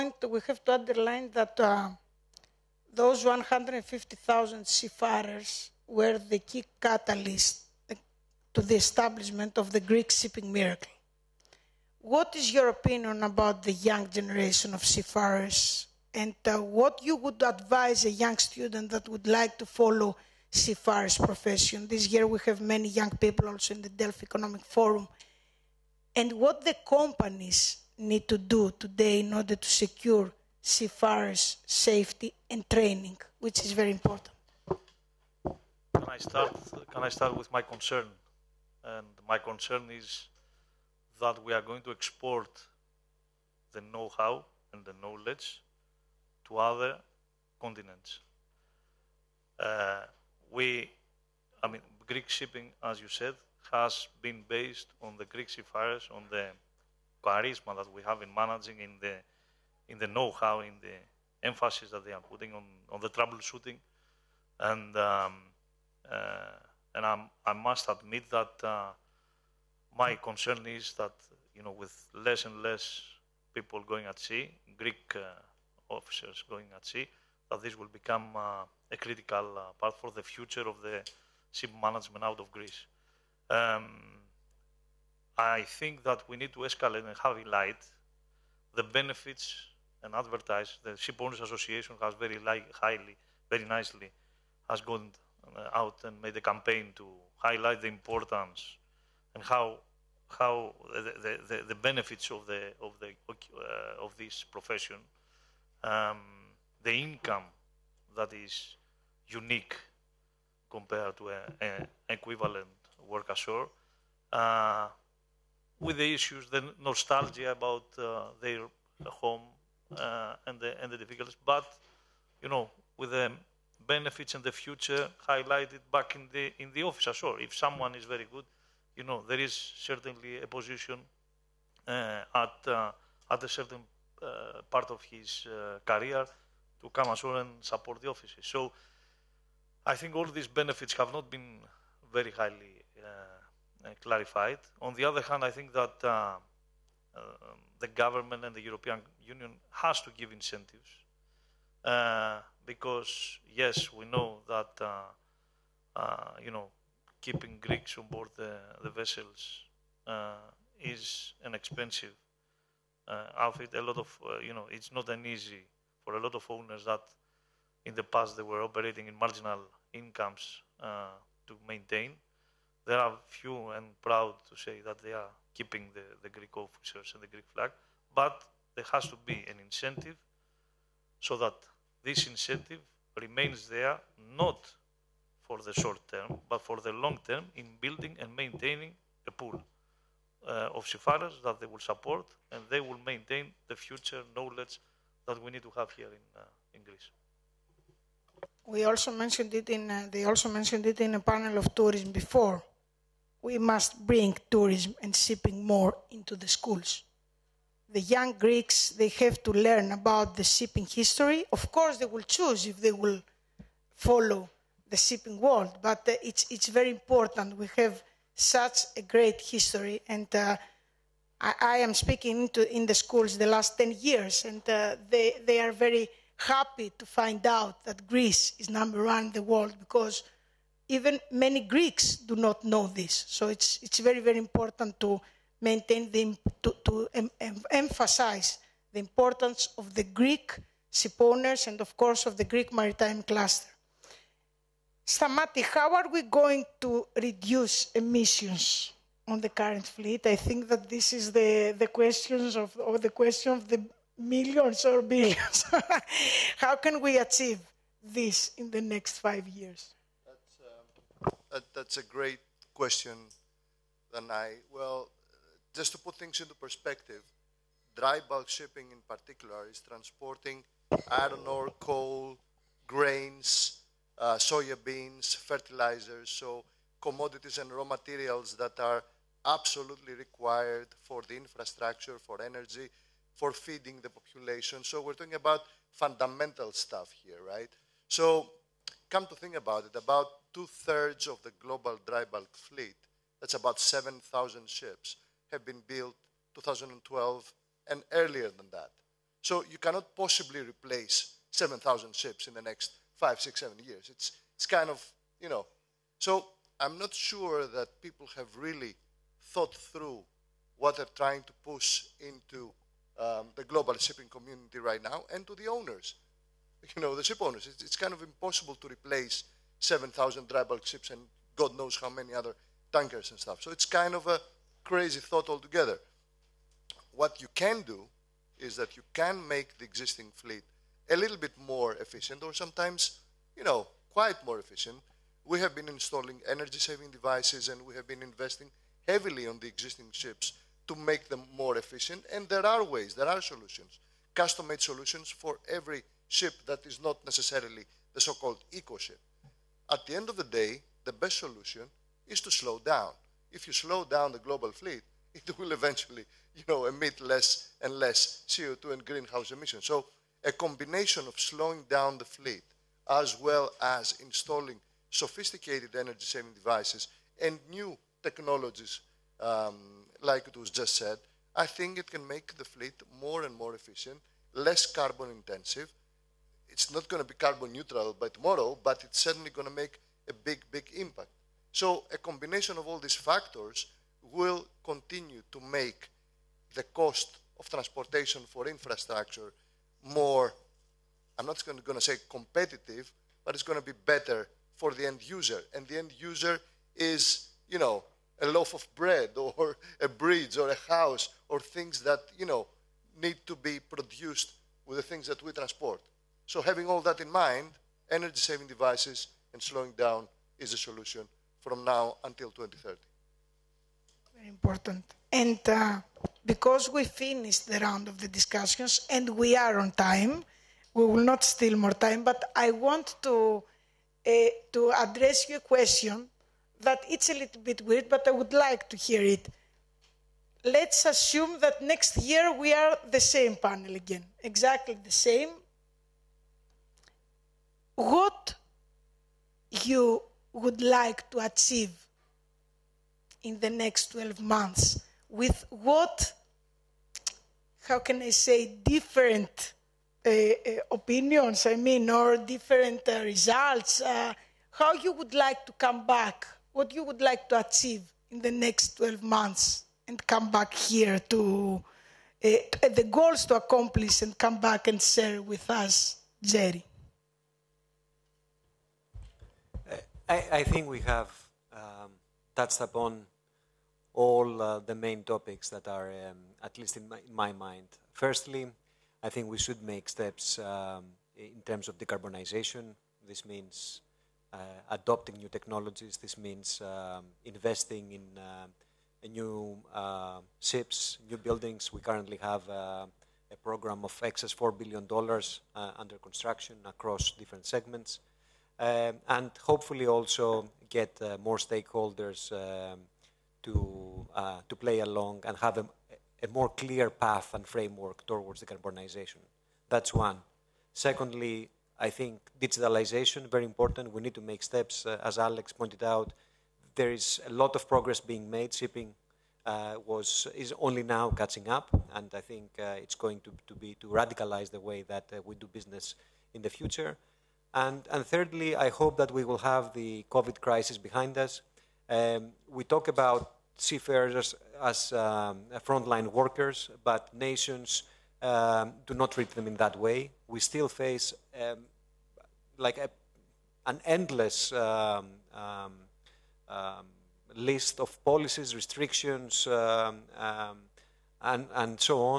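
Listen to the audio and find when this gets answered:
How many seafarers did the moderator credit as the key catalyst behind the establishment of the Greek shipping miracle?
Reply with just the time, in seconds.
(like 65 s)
3 s.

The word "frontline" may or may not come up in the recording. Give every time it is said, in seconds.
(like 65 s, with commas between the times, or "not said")
535 s.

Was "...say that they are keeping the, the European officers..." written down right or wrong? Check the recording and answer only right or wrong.
wrong.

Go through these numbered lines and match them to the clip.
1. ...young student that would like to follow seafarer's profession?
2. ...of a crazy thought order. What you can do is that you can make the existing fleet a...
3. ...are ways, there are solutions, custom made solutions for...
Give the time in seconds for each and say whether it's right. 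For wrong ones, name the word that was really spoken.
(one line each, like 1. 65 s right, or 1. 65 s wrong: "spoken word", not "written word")
1. 18 s right
2. 324 s wrong: "altogether", not "order"
3. 342 s right.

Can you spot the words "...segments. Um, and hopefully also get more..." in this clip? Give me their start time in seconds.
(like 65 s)
497 s.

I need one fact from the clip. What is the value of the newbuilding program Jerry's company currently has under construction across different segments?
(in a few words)
$4 billion.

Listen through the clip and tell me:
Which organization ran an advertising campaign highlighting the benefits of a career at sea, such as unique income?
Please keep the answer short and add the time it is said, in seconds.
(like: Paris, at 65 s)
The Ship Owners Association, at 90 s.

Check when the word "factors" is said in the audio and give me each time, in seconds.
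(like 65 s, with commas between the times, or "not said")
383 s.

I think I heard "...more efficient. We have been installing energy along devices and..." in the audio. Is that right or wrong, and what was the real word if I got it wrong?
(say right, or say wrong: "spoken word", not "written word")
wrong: "saving", not "along".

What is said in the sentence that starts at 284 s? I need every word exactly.
So we're talking about fundamental stuff here, right?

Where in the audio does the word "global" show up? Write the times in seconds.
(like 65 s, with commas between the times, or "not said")
291 s, 313 s, 354 s.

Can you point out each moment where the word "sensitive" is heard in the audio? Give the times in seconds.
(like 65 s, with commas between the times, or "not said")
not said.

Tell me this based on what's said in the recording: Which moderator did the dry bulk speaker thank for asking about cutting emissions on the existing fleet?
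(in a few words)
Danae.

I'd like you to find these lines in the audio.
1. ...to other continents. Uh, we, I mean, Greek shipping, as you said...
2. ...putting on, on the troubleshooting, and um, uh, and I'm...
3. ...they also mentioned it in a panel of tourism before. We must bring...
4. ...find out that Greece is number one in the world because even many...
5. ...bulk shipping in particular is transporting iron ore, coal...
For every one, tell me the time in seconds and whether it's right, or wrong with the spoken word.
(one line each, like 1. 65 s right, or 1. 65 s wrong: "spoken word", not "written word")
1. 46 s right
2. 62 s right
3. 200 s right
4. 227 s right
5. 268 s right.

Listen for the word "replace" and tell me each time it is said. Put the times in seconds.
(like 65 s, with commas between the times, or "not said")
300 s, 318 s.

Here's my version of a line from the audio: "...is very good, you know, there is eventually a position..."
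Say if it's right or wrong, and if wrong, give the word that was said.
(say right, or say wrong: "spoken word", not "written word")
wrong: "certainly", not "eventually".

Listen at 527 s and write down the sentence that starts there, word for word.
And, and thirdly, I hope that we will have the COVID crisis behind us.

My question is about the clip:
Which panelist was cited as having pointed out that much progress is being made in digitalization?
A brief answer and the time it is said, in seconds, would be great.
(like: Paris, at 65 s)
Alex, at 515 s.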